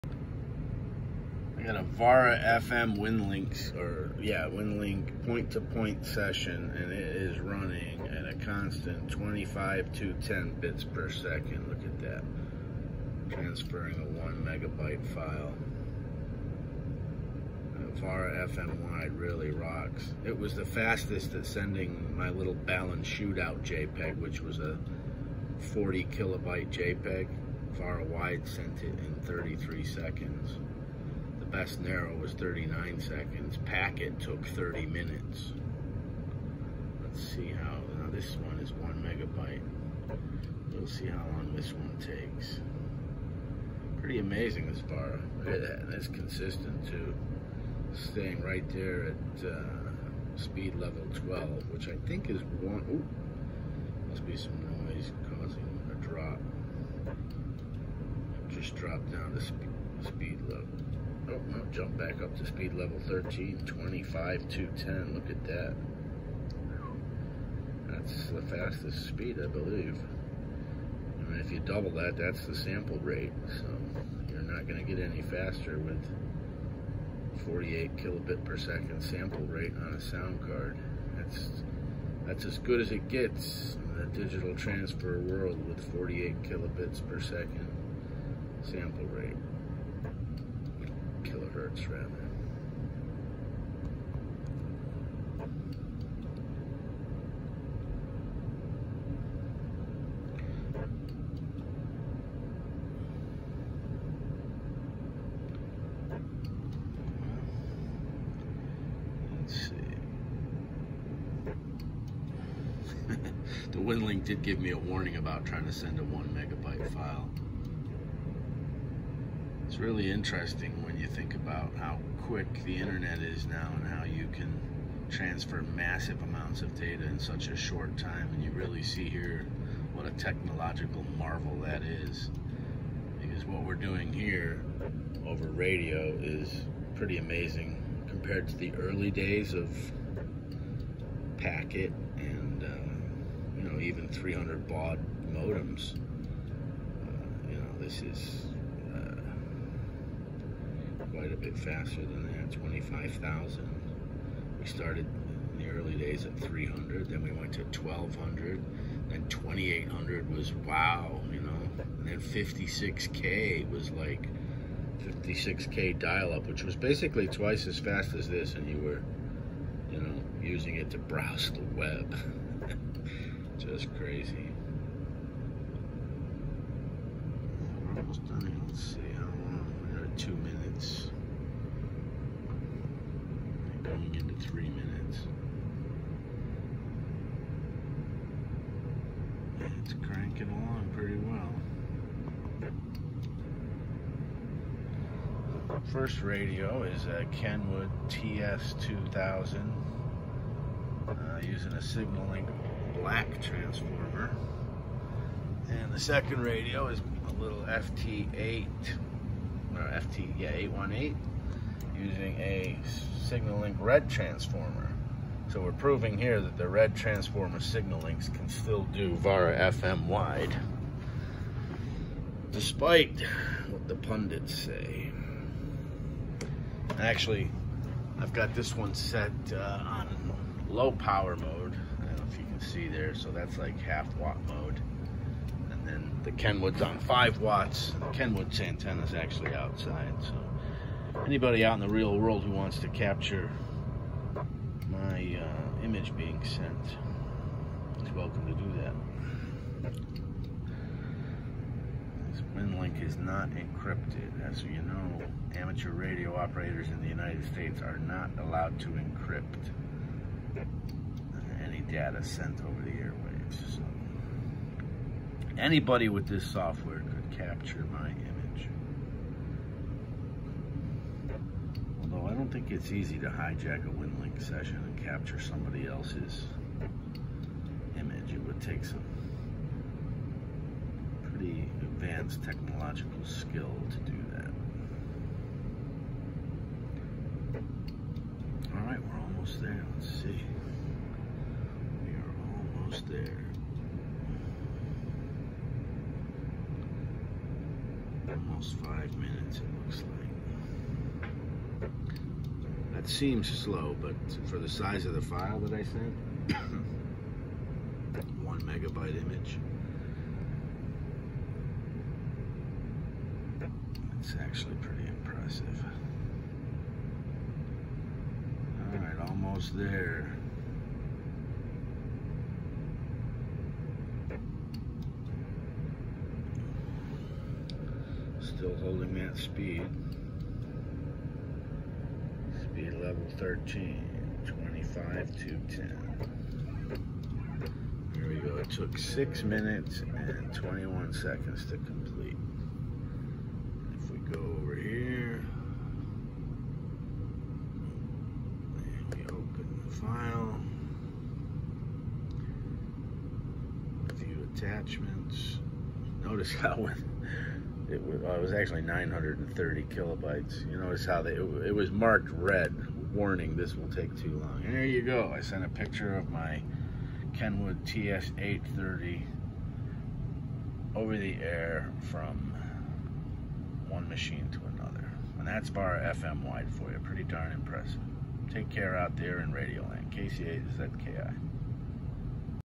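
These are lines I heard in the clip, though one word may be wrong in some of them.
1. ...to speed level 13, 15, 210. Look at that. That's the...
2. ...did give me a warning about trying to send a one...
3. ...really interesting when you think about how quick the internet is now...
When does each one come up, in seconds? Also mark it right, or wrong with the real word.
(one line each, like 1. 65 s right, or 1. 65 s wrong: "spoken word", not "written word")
1. 62 s wrong: "25", not "15"
2. 114 s right
3. 119 s right.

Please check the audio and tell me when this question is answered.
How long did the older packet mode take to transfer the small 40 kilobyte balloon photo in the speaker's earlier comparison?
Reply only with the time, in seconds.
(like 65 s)
34 s.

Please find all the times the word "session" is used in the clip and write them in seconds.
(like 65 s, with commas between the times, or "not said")
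6 s, 274 s.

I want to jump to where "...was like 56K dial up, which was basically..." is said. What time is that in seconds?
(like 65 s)
163 s.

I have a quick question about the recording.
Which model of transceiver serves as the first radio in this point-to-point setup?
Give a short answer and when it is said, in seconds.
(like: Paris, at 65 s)
Kenwood TS2000, at 197 s.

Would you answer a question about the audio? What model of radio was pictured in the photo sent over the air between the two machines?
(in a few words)
Kenwood TS830.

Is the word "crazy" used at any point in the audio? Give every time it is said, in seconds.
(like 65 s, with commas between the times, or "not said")
173 s.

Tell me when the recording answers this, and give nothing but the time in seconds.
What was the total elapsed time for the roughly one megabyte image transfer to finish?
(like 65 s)
338 s.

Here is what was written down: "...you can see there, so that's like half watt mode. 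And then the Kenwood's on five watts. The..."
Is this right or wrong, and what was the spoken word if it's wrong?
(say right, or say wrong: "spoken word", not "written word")
right.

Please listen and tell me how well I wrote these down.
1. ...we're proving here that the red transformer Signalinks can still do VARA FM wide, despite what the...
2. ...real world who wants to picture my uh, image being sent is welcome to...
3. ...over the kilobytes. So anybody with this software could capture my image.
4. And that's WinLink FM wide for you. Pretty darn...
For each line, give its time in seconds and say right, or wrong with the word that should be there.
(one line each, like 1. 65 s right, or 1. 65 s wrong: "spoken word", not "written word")
1. 215 s right
2. 241 s wrong: "capture", not "picture"
3. 262 s wrong: "airwaves", not "kilobytes"
4. 375 s wrong: "Vara", not "WinLink".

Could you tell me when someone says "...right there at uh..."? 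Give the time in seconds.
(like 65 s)
48 s.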